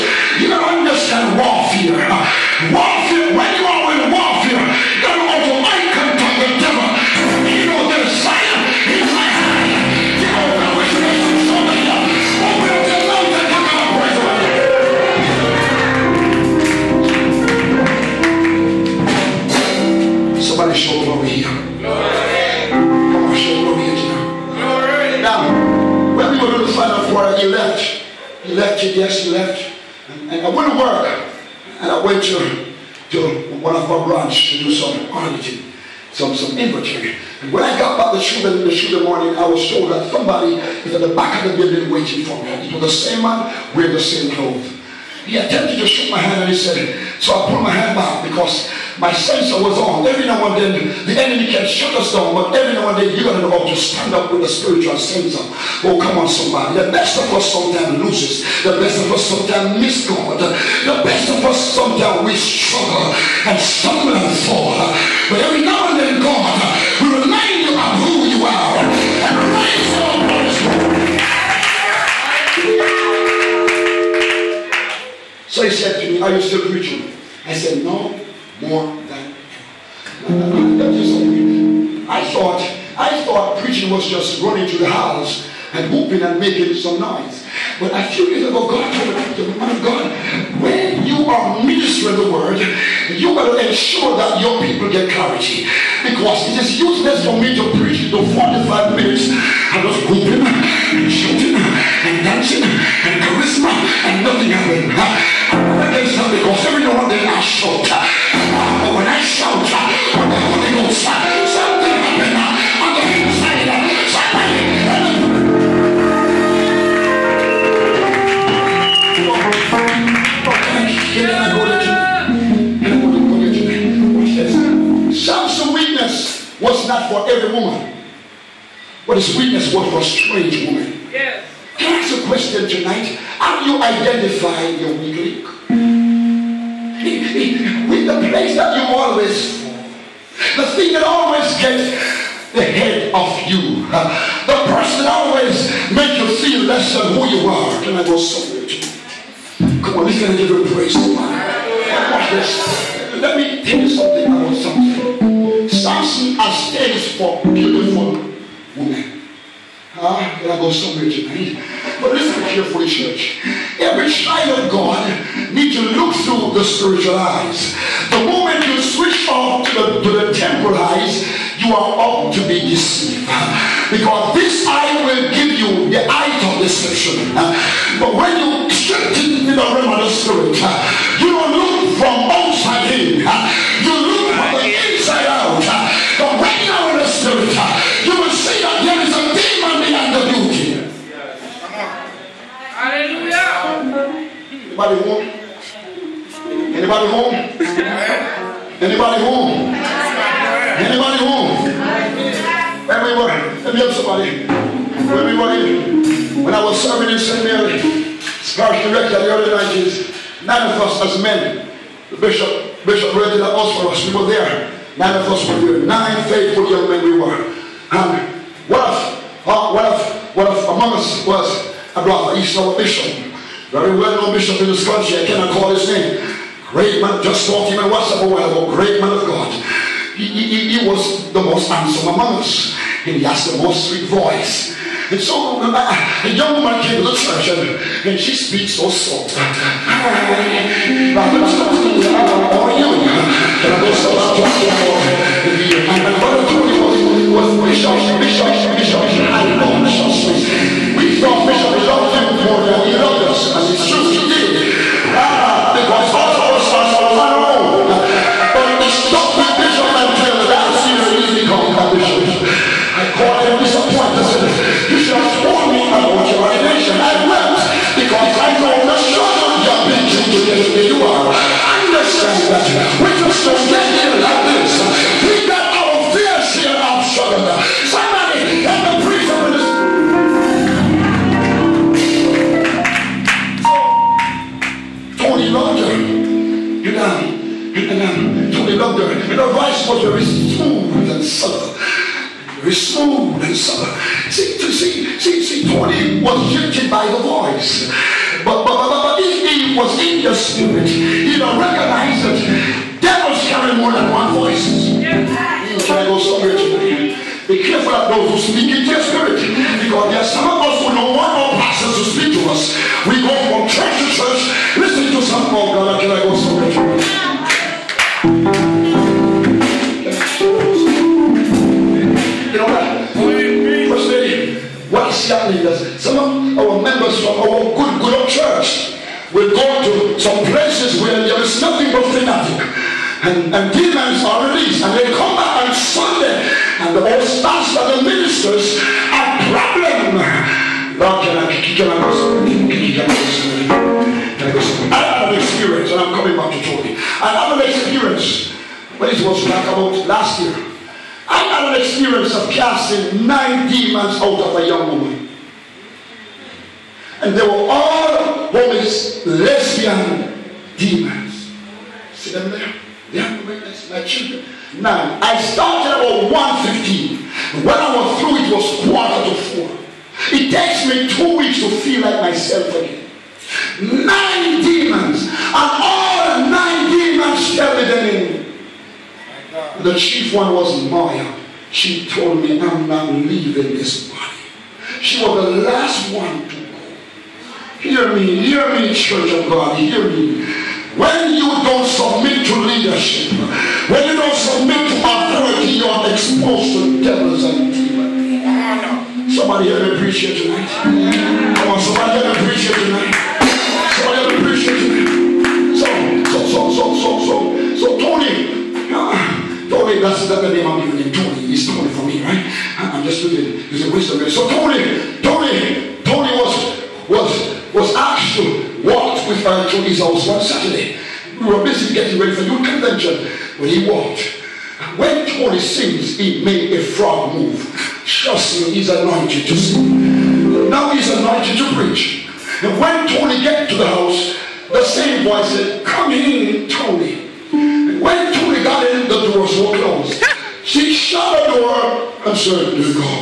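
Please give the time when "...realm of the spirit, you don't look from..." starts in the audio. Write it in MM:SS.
02:59.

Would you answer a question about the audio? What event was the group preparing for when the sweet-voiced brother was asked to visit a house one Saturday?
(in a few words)
new convention.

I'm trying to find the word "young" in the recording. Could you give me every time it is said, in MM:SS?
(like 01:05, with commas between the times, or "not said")
03:36, 03:56, 05:54.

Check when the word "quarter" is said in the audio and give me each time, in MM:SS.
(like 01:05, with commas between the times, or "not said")
06:08.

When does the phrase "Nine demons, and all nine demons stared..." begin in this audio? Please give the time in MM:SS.
06:13.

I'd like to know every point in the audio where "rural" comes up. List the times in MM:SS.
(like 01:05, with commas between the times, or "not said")
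not said.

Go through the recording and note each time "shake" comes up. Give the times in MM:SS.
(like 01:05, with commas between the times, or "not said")
00:45.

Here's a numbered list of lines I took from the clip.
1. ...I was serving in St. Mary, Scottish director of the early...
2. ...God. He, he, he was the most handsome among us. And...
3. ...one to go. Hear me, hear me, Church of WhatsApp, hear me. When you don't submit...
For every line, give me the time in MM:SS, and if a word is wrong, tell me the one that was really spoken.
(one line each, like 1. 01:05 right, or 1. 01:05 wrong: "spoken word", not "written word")
1. 03:26 right
2. 03:49 right
3. 06:26 wrong: "God", not "WhatsApp".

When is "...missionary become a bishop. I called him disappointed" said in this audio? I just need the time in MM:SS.
04:21.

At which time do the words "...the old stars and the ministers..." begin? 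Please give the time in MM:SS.
05:36.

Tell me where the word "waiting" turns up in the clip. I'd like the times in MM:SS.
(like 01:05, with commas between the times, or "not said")
00:41.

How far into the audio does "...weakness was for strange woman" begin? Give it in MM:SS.
02:09.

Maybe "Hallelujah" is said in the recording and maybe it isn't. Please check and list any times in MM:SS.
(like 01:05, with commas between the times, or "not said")
03:12.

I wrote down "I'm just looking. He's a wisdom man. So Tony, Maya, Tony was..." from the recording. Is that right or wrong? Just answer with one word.
wrong.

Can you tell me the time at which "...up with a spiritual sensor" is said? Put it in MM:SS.
00:54.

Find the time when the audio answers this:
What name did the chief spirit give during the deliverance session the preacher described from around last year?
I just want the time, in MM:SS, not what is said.
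06:20.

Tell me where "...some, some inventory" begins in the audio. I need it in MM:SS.
00:36.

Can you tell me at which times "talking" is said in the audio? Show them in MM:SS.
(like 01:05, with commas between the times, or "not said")
03:47, 04:04.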